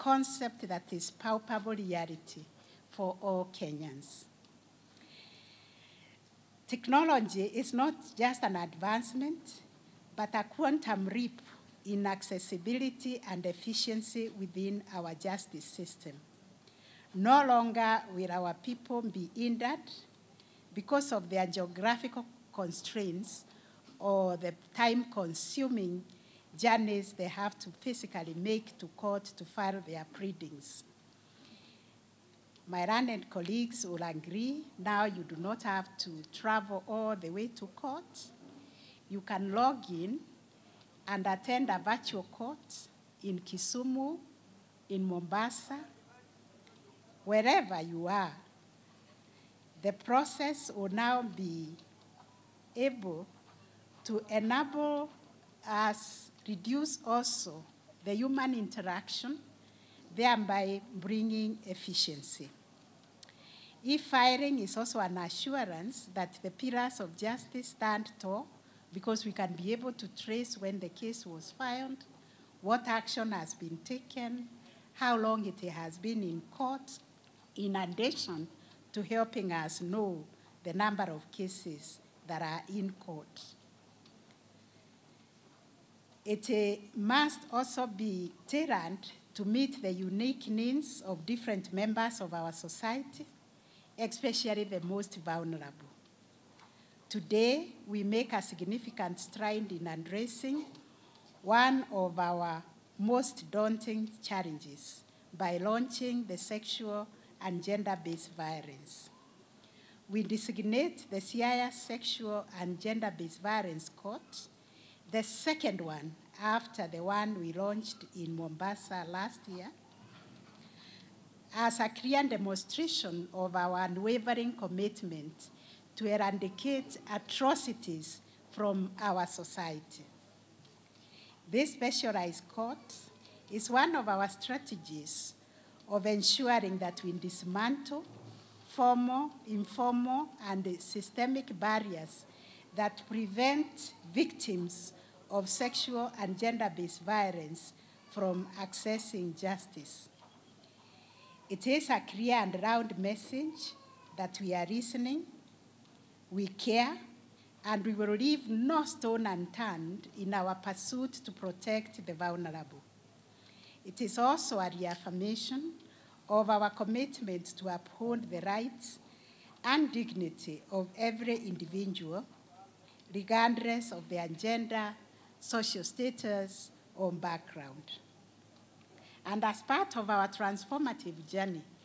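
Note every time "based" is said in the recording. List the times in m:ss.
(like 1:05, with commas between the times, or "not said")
1:47, 1:52, 2:26.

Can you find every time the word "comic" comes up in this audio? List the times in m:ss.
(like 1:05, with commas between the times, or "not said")
not said.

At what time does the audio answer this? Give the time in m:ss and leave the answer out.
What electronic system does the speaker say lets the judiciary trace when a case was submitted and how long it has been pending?
1:03.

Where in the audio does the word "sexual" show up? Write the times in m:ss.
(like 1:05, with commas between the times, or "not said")
1:46, 1:51, 2:25.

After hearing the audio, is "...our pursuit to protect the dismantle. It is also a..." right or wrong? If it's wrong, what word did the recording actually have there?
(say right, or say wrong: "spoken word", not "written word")
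wrong: "vulnerable", not "dismantle".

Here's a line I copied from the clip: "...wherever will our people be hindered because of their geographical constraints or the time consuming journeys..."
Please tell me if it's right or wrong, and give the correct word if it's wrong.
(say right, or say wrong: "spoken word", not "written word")
wrong: "longer", not "wherever".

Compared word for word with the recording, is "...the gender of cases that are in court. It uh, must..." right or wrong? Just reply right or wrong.
wrong.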